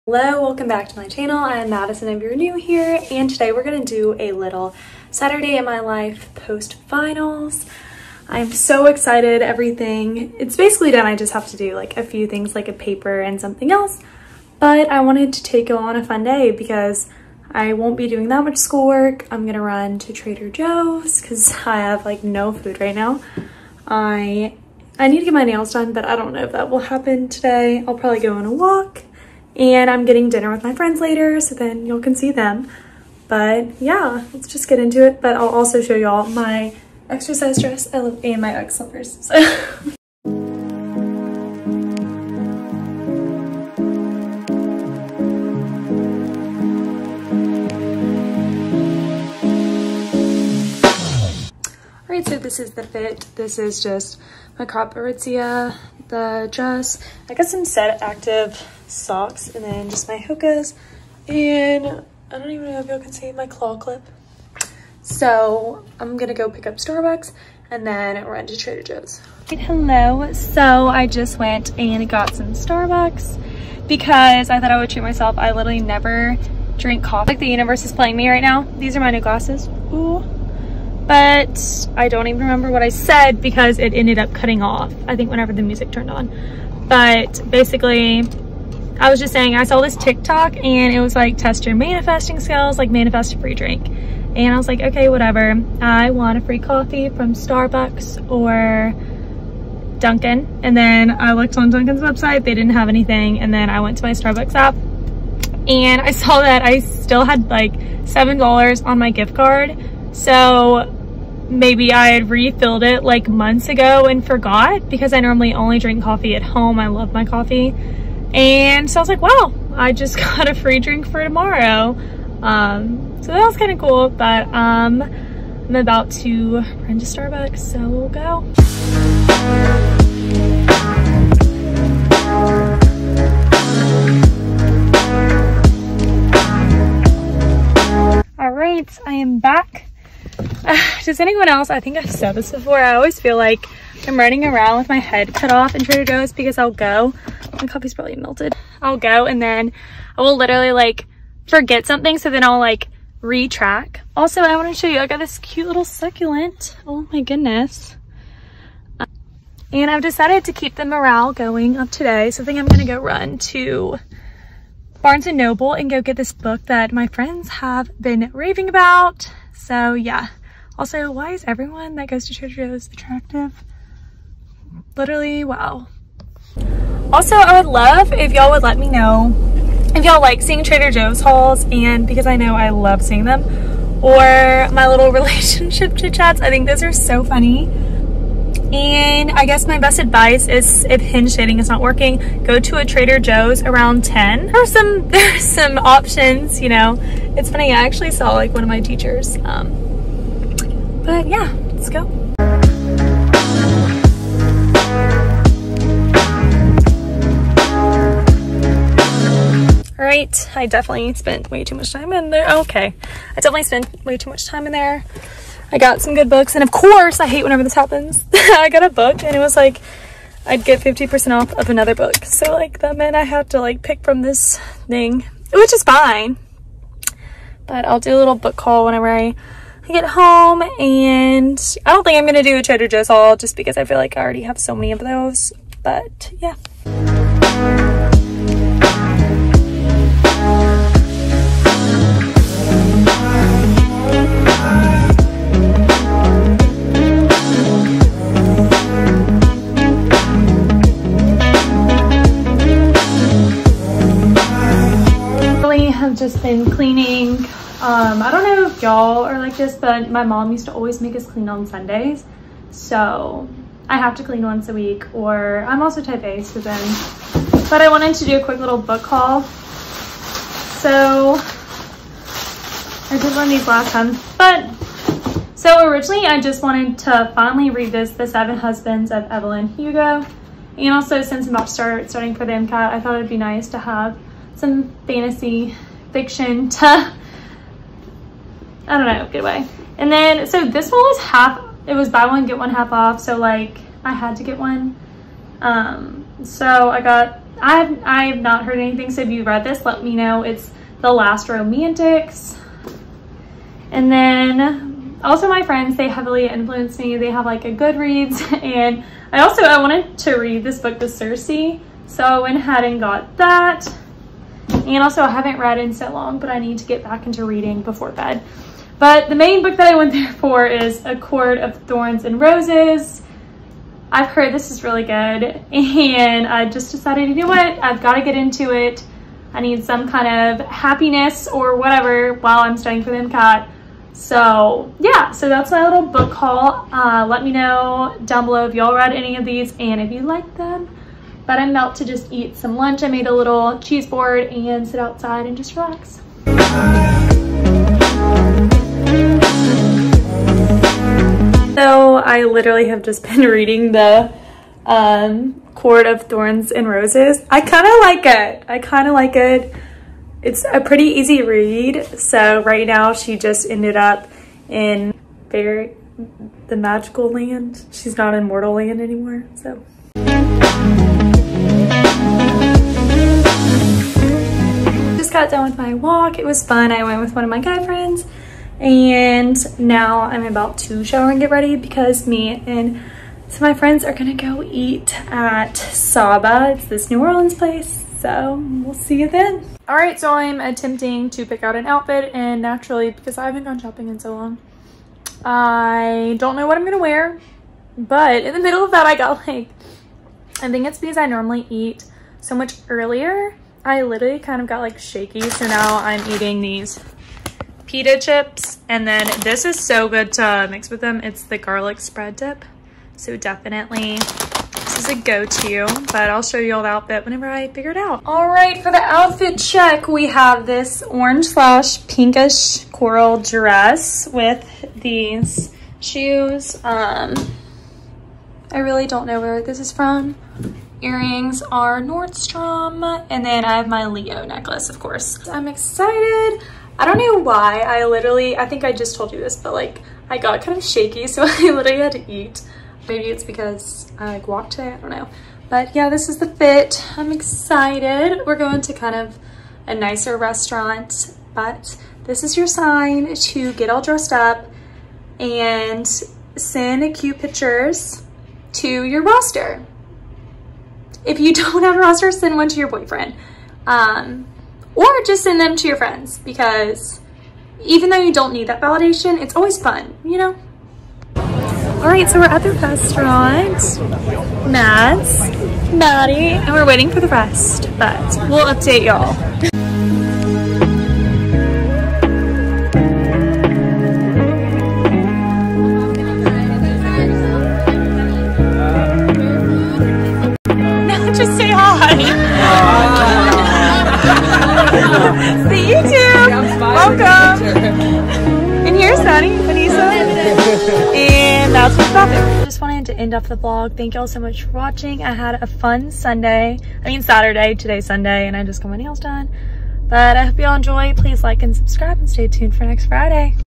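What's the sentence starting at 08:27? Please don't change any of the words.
I mean Saturday, today's Sunday, and I just got my nails done.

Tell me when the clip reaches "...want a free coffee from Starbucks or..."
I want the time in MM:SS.
01:36.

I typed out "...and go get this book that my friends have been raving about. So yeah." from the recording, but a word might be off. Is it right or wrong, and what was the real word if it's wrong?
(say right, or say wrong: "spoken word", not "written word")
right.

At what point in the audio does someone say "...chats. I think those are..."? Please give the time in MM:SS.
03:06.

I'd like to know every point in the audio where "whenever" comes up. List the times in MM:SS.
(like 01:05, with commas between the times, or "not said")
01:25, 03:37, 03:48, 06:57.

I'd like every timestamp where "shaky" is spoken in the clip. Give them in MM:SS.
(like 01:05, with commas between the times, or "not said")
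06:44, 07:20.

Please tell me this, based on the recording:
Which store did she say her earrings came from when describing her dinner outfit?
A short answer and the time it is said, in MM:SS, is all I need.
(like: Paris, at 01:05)
Nordstrom, at 07:12.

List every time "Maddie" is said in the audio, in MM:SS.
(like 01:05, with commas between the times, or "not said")
07:55.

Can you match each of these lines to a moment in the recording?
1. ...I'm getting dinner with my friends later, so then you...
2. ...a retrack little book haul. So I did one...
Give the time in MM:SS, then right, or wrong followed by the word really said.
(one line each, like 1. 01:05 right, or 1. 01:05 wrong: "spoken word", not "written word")
1. 00:29 right
2. 04:28 wrong: "quick", not "retrack".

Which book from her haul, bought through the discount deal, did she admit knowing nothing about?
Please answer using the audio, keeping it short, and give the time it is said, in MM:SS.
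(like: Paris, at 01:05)
The Last Romantics, at 05:01.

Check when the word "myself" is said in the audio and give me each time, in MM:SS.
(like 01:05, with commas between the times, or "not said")
01:15.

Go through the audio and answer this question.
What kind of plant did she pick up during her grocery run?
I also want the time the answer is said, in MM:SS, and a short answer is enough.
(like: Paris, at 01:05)
Succulent, at 02:35.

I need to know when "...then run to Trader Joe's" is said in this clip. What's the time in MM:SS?
01:07.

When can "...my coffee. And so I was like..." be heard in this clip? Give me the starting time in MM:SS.
01:57.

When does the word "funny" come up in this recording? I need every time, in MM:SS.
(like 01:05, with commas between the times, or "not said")
03:07, 03:17.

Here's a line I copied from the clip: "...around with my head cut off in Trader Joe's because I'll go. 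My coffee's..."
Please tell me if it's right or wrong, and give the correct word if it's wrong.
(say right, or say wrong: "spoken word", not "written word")
right.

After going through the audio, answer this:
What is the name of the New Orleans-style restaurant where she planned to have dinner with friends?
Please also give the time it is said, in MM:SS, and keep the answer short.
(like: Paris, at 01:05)
Saba, at 06:25.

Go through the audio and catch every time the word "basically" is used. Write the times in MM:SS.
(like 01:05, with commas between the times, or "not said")
00:10, 01:27.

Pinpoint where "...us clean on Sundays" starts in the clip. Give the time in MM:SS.
04:21.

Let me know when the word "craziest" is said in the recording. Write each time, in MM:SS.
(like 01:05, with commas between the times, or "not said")
not said.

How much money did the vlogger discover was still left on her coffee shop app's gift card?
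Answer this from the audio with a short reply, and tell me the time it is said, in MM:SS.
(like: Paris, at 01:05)
$7, at 01:47.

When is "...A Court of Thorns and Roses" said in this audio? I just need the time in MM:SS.
05:21.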